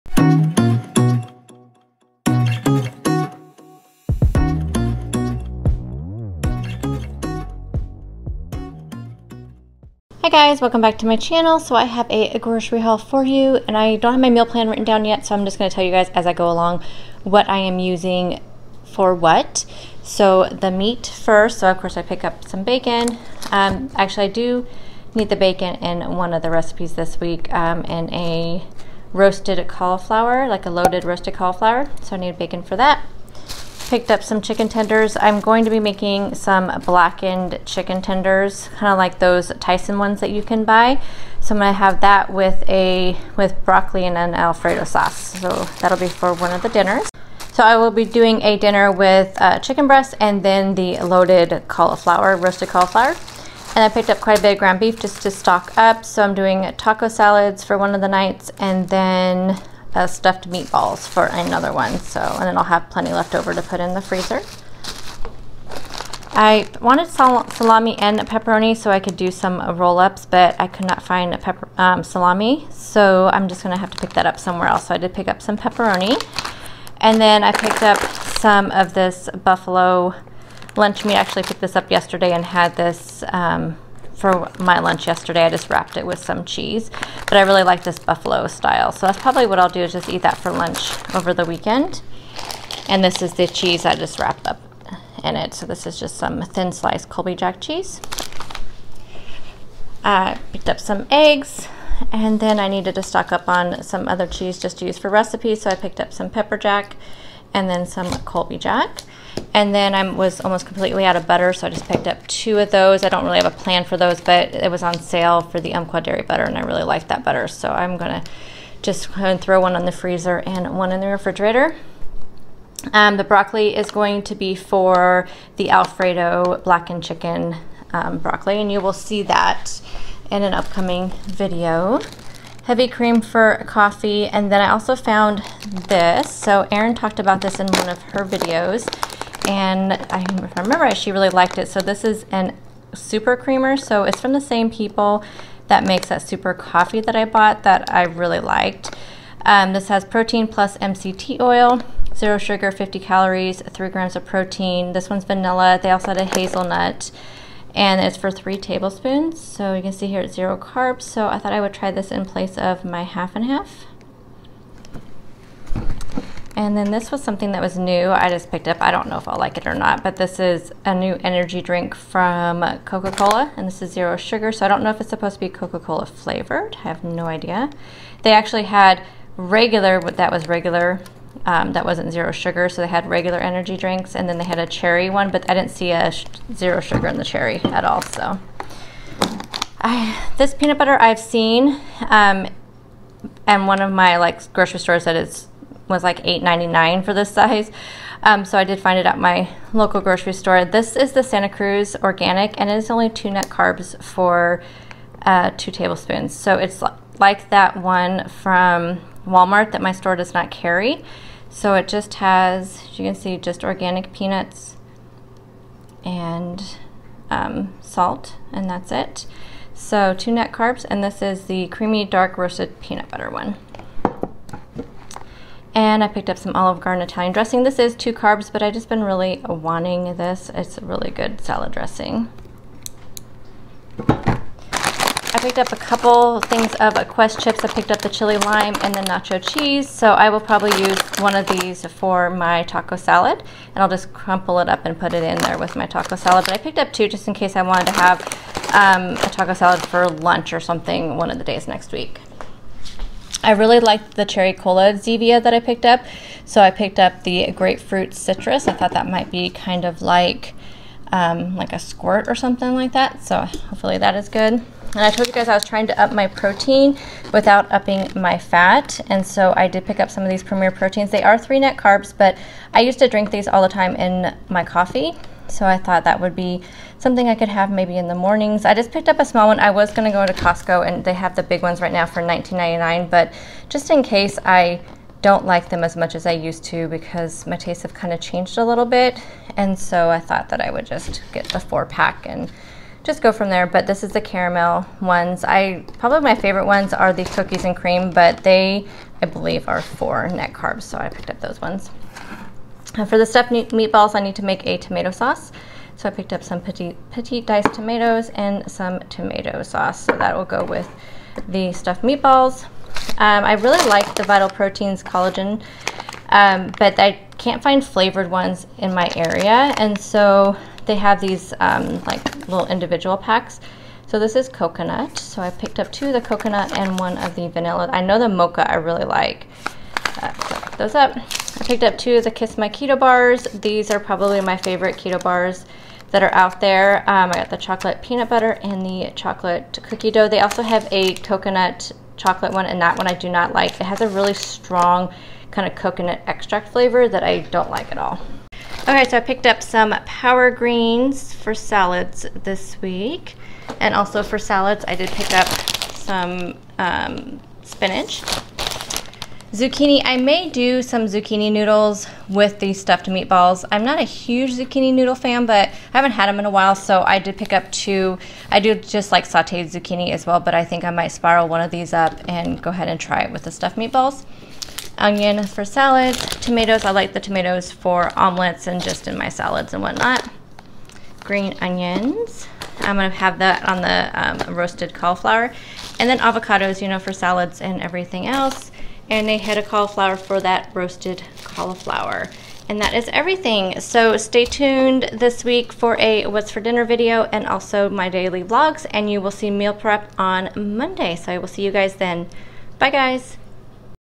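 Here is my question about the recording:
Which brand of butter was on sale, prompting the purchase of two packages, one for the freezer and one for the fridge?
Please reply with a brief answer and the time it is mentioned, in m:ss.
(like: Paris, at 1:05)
Umpqua Dairy, at 1:55.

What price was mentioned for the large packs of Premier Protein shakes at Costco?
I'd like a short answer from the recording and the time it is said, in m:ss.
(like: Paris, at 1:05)
$19.99, at 4:42.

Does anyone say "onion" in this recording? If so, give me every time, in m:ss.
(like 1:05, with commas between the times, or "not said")
6:14, 6:21.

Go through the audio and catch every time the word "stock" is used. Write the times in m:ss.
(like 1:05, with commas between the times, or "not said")
0:55, 1:43.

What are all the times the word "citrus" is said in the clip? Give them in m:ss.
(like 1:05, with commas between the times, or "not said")
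4:18.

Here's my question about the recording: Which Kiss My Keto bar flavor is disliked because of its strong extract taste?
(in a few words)
coconut chocolate.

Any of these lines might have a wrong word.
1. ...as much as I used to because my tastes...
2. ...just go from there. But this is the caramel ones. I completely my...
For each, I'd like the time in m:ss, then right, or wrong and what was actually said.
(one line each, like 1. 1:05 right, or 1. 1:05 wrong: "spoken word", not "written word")
1. 4:45 right
2. 4:53 wrong: "probably", not "completely".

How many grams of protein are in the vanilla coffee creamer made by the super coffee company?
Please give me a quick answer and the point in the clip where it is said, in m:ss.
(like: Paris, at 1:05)
3, at 2:33.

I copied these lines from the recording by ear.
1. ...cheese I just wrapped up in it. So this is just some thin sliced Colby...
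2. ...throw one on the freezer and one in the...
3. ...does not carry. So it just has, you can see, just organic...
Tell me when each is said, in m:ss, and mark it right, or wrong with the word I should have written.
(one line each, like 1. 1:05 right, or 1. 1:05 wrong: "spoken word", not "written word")
1. 1:33 right
2. 1:59 right
3. 3:30 right.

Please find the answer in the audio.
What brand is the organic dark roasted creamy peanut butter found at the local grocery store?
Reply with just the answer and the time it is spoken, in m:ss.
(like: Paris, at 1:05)
Santa Cruz Organic, at 3:21.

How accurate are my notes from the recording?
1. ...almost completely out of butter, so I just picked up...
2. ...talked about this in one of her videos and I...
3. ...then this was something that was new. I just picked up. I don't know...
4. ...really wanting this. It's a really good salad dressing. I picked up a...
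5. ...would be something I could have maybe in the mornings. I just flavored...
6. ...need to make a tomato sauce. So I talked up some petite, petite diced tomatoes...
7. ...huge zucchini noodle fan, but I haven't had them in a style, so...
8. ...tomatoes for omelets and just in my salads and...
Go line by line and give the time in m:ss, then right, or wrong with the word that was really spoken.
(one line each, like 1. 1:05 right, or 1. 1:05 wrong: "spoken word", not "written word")
1. 1:50 right
2. 2:16 right
3. 2:46 right
4. 3:49 right
5. 4:36 wrong: "picked", not "flavored"
6. 5:04 wrong: "picked", not "talked"
7. 6:04 wrong: "while", not "style"
8. 6:17 right.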